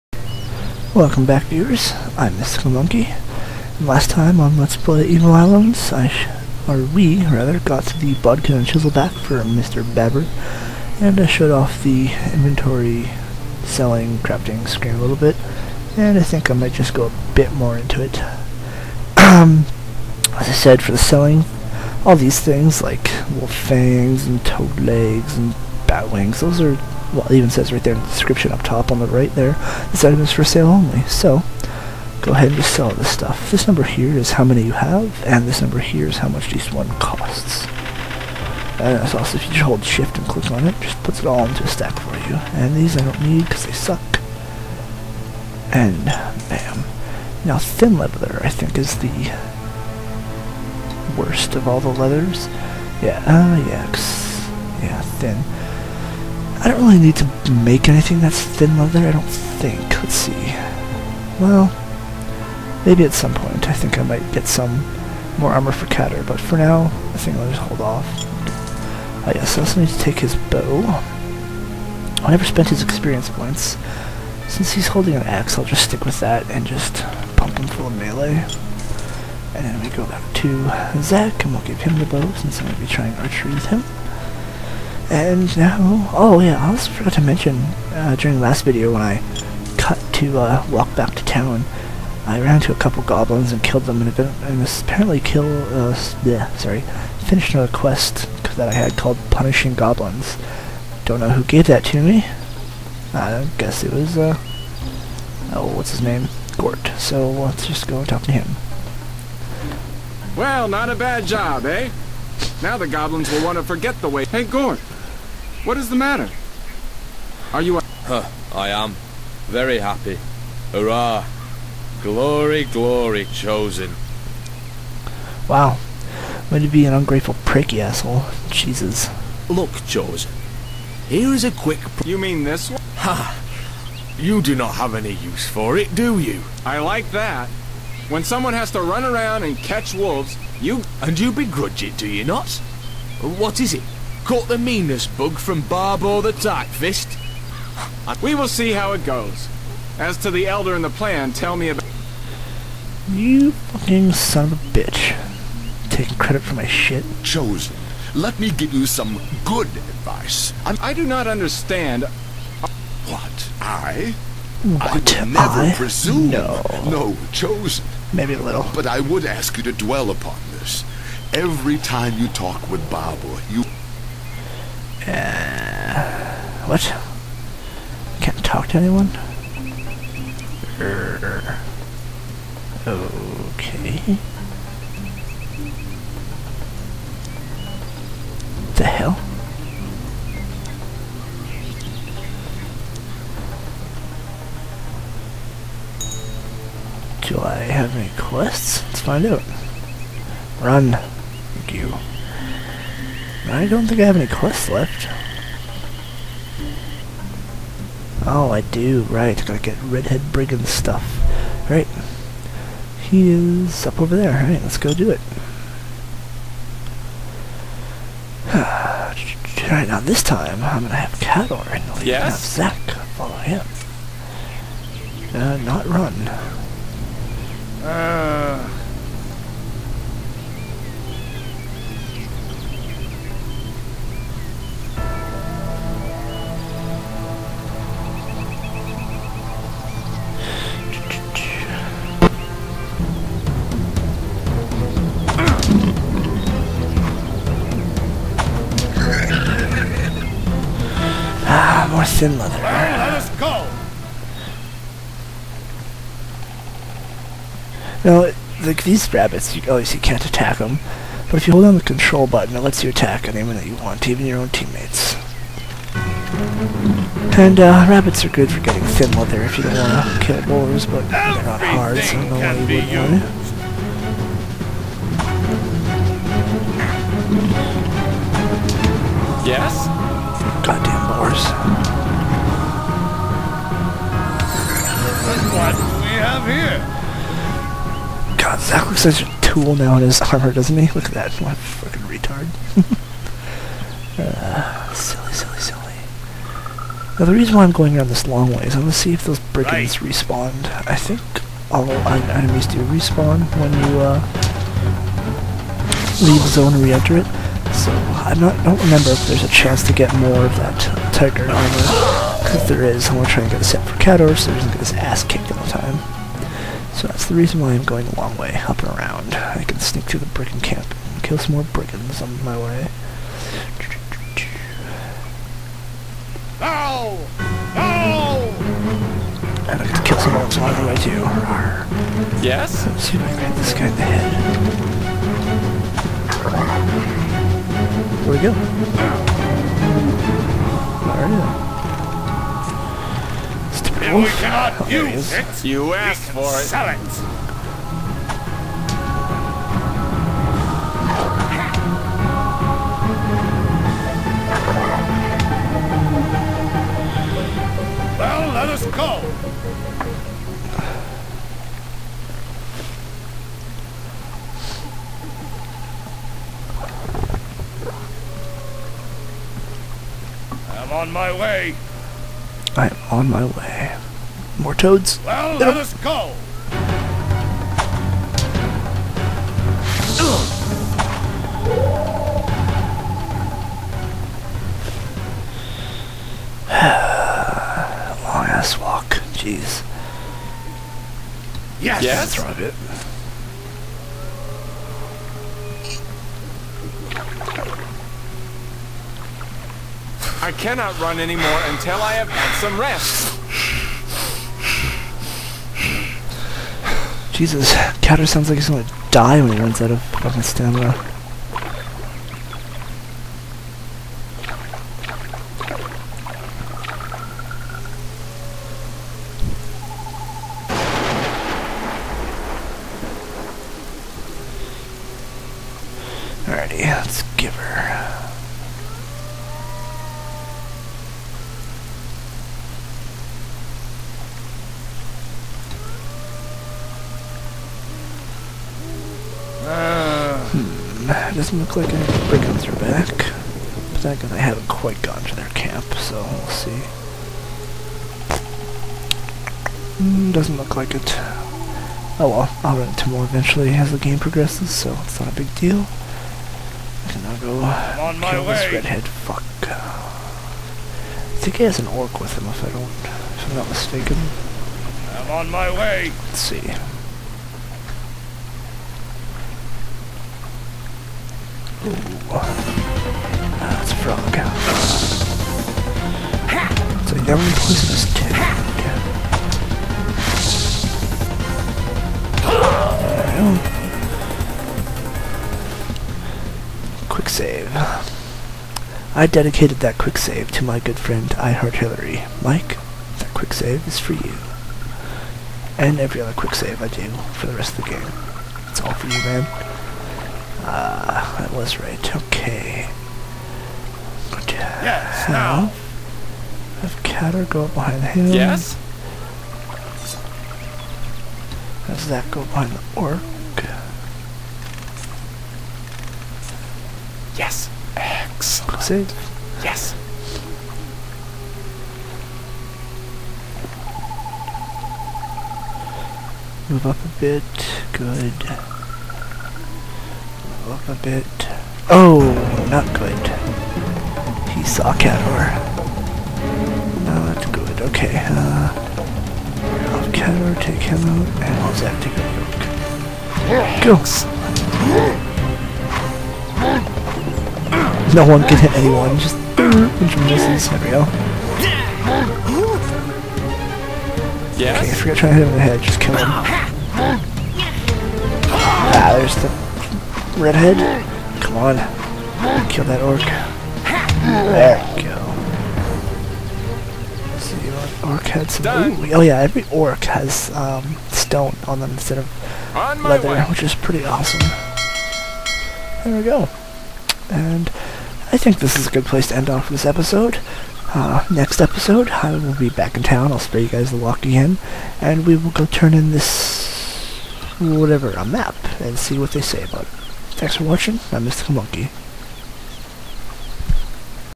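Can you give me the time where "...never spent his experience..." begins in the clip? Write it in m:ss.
1:12.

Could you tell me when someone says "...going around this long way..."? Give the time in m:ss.
4:57.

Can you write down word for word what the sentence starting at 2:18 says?
When someone has to run around and catch wolves, you...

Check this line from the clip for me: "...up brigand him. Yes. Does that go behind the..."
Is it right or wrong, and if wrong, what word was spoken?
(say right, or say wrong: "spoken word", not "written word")
wrong: "behind", not "brigand".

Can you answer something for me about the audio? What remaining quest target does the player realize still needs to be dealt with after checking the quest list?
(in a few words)
Redhead Brigand.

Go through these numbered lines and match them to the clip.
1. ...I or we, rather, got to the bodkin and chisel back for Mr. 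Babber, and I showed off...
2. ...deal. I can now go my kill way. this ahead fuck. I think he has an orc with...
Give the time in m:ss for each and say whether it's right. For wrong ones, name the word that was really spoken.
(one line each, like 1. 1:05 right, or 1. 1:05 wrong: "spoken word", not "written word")
1. 0:05 right
2. 7:35 wrong: "redhead", not "ahead".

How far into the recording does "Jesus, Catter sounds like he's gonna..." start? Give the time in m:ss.
6:47.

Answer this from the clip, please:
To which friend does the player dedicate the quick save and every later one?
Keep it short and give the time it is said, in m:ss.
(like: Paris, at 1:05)
I Heart Hillary, at 8:11.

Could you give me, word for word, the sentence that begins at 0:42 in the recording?
And these I don't need because they suck.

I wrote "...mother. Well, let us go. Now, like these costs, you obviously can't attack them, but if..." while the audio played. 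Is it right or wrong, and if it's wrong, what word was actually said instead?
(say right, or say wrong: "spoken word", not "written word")
wrong: "rabbits", not "costs".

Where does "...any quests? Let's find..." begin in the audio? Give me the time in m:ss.
3:17.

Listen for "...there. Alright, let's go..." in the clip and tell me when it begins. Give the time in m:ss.
3:34.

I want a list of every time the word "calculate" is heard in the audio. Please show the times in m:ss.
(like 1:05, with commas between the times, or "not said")
not said.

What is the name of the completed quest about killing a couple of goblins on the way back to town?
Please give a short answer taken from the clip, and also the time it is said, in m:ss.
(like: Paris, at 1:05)
Punishing Goblins, at 1:39.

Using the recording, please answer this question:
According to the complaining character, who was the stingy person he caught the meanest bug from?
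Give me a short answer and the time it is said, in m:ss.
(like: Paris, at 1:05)
Barbo the Tightfist, at 2:25.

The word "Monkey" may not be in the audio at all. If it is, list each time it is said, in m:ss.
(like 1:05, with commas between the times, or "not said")
0:02, 9:51.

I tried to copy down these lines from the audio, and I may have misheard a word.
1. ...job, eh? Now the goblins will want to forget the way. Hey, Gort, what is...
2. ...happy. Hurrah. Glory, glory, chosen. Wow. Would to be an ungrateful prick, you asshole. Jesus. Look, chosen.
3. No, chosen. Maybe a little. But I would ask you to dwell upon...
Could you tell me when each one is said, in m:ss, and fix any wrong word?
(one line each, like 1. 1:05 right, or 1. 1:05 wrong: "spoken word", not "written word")
1. 1:51 right
2. 1:59 right
3. 2:46 right.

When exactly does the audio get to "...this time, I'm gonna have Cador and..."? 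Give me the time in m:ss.
3:39.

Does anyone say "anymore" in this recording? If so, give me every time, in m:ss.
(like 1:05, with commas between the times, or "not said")
6:41.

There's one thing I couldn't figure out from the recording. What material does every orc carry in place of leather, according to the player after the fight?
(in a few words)
Stone.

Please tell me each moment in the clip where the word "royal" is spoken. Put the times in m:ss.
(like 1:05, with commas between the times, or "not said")
not said.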